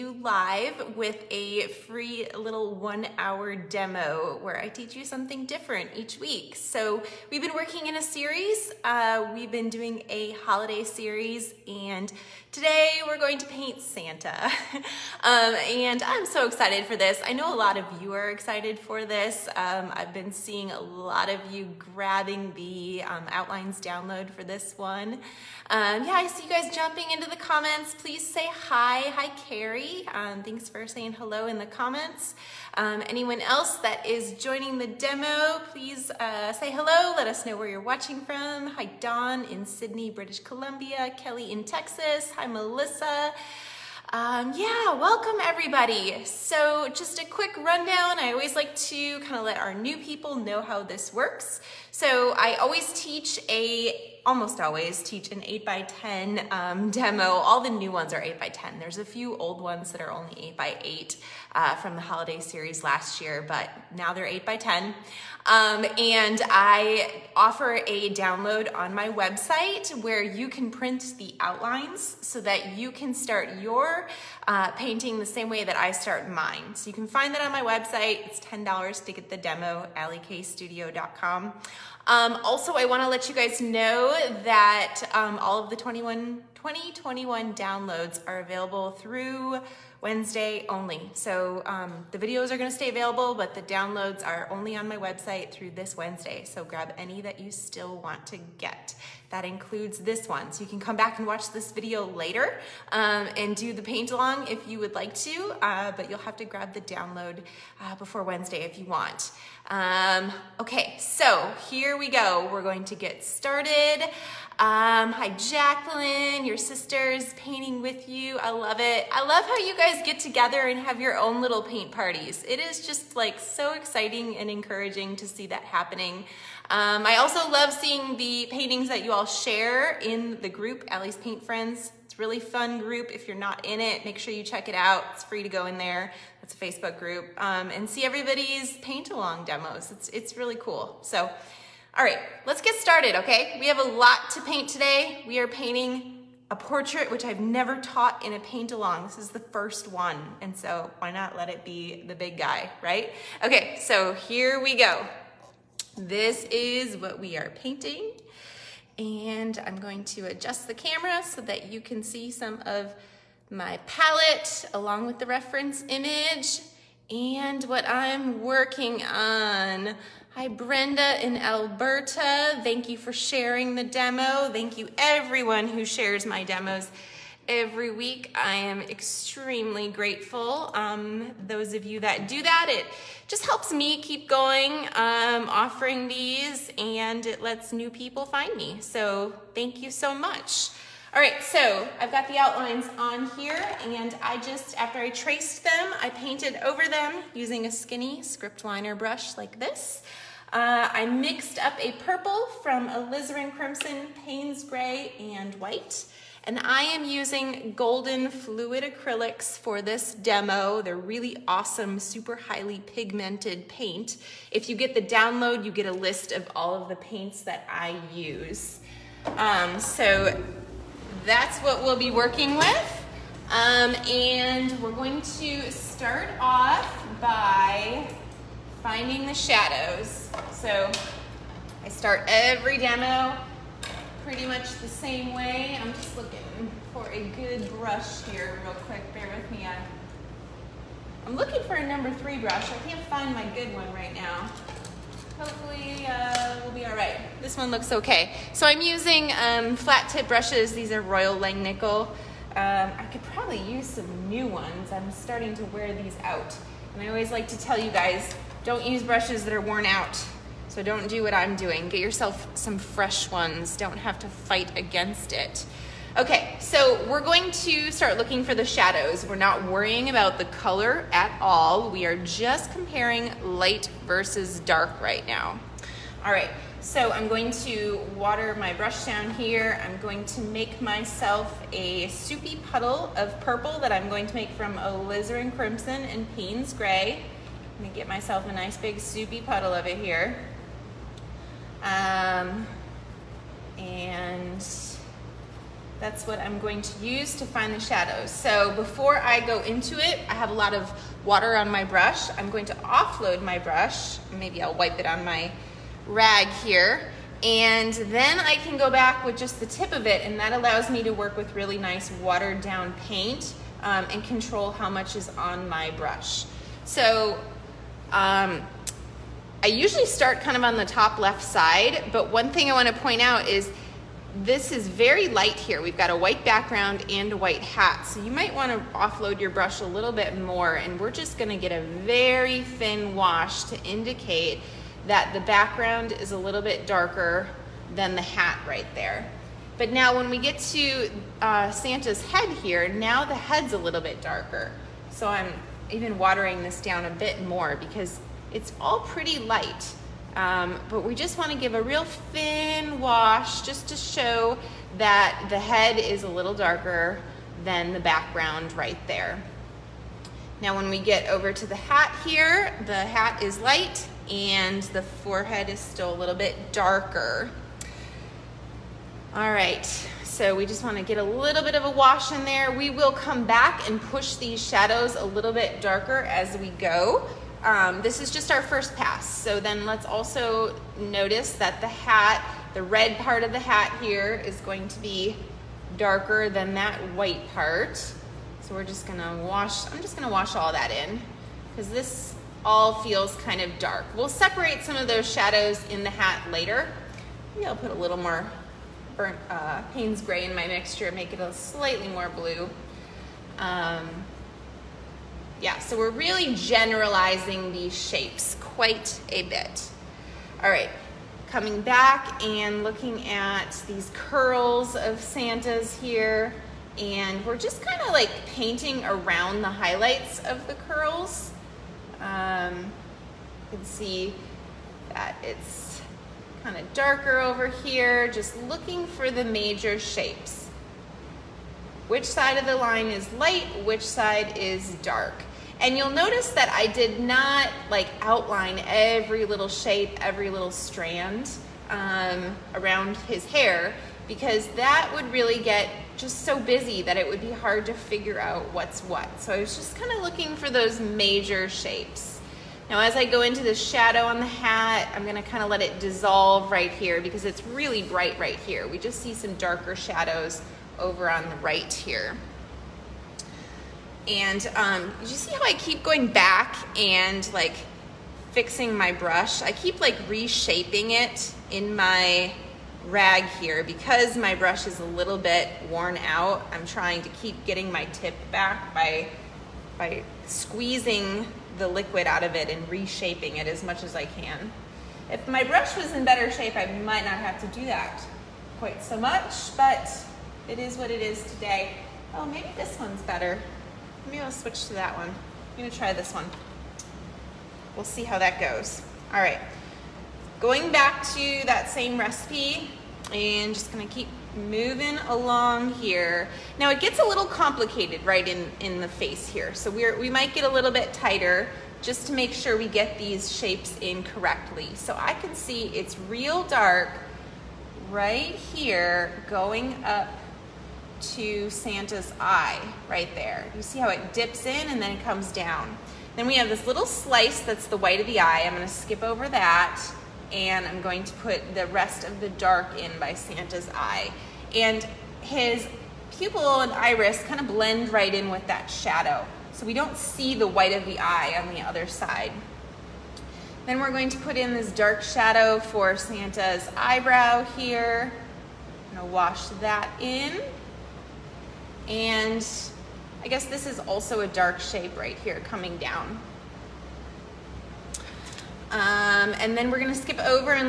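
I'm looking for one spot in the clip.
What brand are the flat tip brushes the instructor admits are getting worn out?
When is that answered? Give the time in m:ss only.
4:11.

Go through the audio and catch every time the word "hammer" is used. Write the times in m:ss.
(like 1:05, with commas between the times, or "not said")
not said.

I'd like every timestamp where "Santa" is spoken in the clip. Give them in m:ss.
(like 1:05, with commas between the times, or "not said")
0:13, 5:41, 6:55, 8:41, 8:53, 9:06.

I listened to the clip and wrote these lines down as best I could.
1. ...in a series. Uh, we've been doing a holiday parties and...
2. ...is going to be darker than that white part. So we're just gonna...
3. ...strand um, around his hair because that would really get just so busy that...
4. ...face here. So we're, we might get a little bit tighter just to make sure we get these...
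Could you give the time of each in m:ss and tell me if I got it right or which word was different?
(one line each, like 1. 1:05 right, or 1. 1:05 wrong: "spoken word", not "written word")
1. 0:07 wrong: "series", not "parties"
2. 6:24 right
3. 7:20 right
4. 8:29 right.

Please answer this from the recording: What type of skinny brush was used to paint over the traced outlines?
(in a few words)
script liner.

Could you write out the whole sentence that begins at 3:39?
Um, so that's what we'll be working with.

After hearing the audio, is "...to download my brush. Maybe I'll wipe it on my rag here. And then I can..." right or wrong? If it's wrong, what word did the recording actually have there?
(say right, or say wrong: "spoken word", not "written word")
wrong: "offload", not "download".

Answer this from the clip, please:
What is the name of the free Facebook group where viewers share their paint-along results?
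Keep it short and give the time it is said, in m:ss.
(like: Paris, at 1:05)
Ali's Paint Friends, at 2:10.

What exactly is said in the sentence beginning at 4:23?
Don't have to fight against it.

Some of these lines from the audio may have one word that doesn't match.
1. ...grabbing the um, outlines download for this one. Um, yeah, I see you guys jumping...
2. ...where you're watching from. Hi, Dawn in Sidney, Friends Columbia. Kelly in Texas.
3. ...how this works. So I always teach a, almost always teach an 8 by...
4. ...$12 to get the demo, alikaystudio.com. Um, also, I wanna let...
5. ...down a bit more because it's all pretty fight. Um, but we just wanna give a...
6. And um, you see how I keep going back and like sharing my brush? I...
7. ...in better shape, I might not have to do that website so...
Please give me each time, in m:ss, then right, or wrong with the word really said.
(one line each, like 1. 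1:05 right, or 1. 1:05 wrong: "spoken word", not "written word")
1. 0:21 right
2. 0:37 wrong: "British", not "Friends"
3. 0:50 right
4. 1:18 wrong: "10", not "12"
5. 5:46 wrong: "light", not "fight"
6. 7:44 wrong: "fixing", not "sharing"
7. 8:06 wrong: "quite", not "website".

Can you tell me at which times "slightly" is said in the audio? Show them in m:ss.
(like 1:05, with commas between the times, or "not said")
6:41.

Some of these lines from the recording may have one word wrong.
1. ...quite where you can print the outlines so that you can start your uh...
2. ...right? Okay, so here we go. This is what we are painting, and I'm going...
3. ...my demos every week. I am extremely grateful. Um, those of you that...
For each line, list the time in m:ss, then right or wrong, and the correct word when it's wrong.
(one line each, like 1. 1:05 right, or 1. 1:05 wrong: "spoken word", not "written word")
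1. 1:09 wrong: "website", not "quite"
2. 2:32 right
3. 2:56 right.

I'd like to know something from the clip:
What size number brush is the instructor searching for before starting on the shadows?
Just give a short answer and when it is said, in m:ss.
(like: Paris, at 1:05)
3, at 4:02.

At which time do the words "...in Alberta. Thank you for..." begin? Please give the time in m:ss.
2:51.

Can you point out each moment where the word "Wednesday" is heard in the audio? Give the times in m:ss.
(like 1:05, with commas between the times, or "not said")
1:30, 1:35, 1:48.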